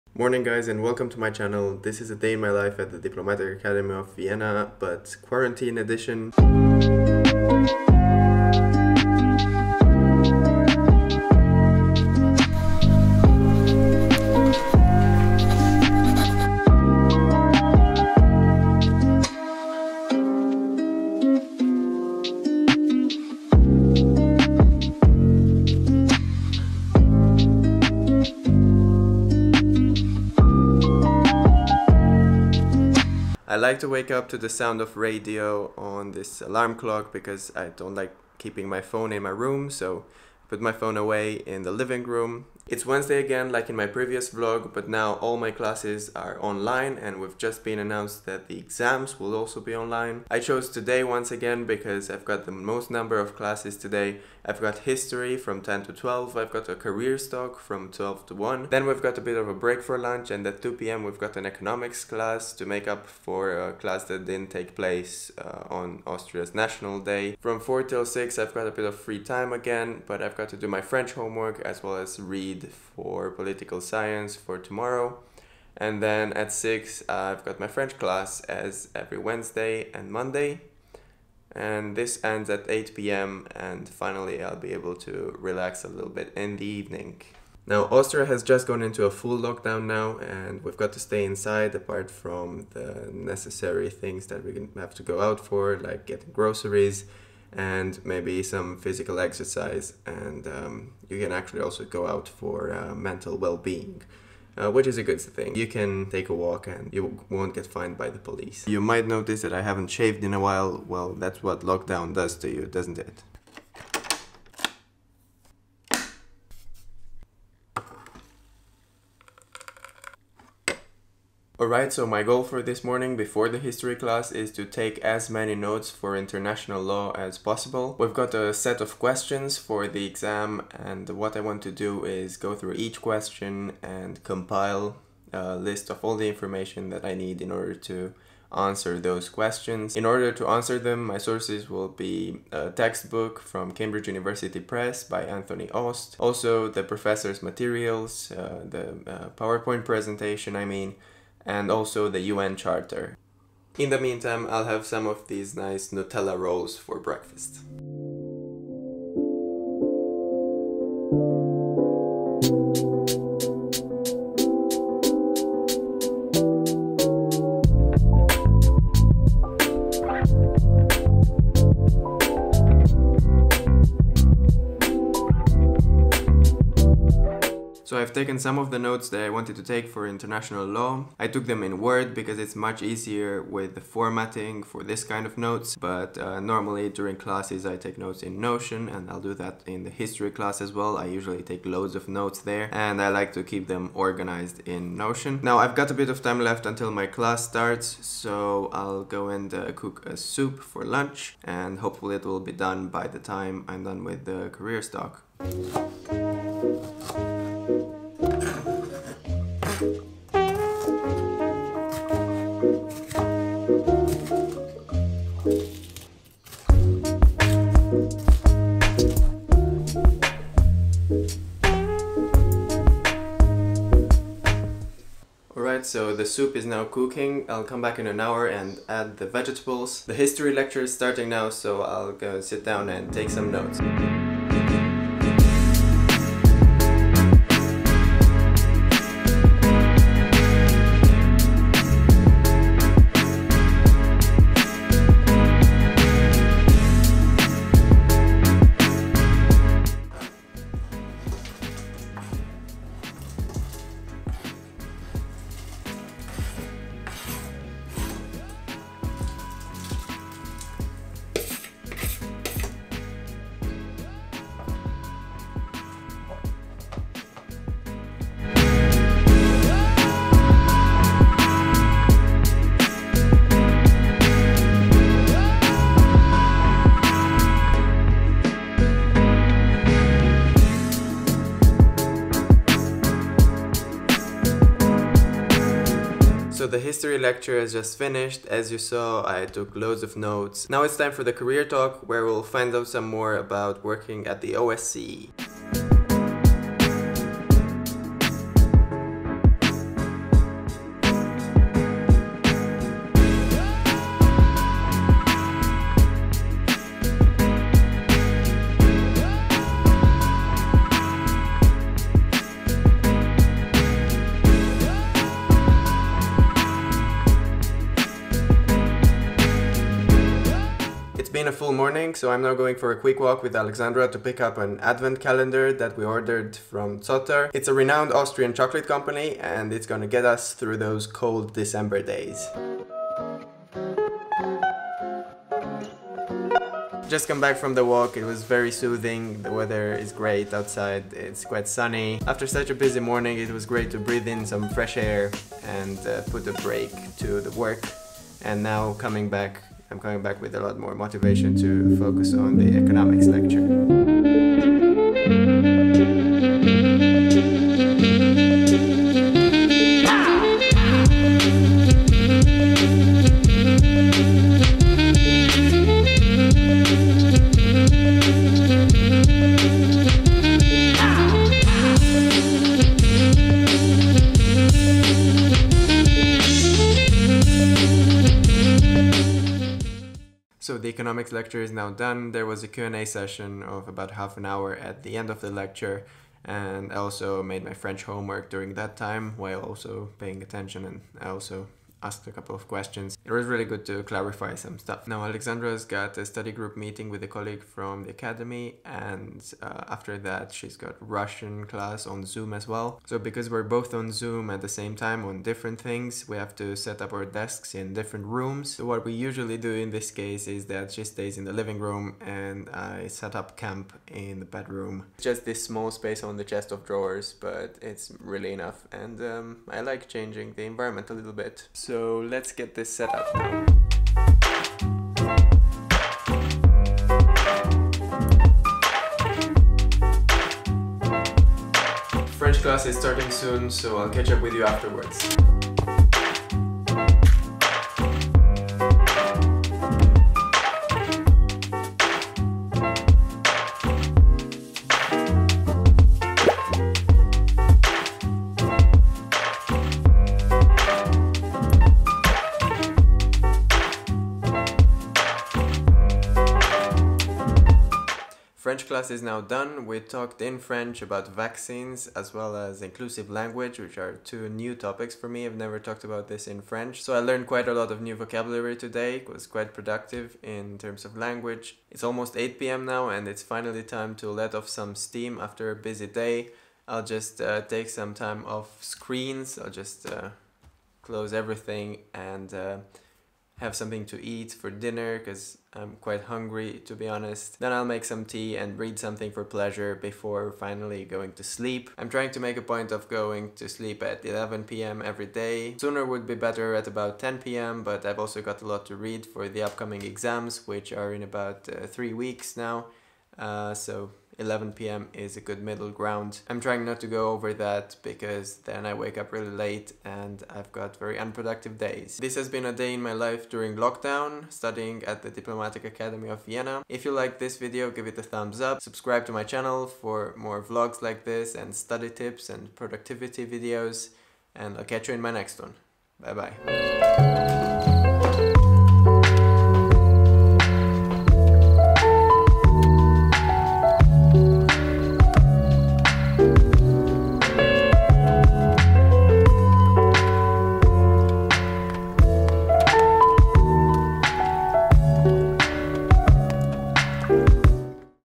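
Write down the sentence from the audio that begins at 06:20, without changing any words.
So the economics lecture is now done.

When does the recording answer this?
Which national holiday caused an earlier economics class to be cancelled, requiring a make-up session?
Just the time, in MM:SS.
01:06.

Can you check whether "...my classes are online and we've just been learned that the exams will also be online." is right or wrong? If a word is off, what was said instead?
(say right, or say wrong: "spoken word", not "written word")
wrong: "announced", not "learned".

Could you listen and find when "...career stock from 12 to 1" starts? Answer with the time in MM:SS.
00:56.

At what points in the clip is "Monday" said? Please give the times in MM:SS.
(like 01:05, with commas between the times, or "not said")
01:20.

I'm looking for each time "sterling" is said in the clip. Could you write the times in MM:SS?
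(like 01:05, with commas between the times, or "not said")
not said.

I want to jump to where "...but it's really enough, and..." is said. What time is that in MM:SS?
06:57.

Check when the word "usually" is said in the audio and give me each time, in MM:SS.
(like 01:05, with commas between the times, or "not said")
03:11, 06:49.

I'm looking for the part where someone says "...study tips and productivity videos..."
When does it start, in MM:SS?
08:41.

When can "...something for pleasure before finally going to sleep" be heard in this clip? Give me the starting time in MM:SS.
08:08.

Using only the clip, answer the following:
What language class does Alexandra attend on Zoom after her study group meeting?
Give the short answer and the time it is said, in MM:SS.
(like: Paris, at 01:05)
Russian, at 06:40.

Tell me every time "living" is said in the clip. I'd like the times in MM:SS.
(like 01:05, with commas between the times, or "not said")
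00:41, 06:51.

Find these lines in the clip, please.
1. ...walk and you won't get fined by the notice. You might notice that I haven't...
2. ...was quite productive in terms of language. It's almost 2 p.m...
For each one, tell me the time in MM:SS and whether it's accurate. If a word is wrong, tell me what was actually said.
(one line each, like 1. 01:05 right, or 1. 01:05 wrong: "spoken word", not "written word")
1. 01:46 wrong: "police", not "notice"
2. 07:49 wrong: "8", not "2".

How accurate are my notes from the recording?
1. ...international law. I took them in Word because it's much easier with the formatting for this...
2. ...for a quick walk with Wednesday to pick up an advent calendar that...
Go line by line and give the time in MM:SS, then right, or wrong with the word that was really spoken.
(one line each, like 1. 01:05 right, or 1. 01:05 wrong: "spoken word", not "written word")
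1. 03:00 right
2. 05:22 wrong: "Alexandra", not "Wednesday".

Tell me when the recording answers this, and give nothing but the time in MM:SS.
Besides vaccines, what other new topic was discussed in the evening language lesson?
07:42.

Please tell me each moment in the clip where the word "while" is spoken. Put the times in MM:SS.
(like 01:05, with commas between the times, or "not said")
01:50, 06:29.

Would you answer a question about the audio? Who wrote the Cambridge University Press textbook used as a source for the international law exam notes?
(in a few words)
Anthony Aust.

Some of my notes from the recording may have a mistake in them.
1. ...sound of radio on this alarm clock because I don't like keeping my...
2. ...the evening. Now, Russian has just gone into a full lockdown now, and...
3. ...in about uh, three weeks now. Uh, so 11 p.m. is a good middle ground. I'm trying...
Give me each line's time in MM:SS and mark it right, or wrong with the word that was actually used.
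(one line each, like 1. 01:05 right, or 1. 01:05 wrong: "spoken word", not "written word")
1. 00:34 right
2. 01:26 wrong: "Austria", not "Russian"
3. 08:21 right.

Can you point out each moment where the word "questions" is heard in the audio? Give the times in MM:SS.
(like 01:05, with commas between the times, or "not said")
02:08, 02:12, 02:19, 06:32.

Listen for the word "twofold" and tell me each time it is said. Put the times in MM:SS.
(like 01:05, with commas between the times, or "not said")
not said.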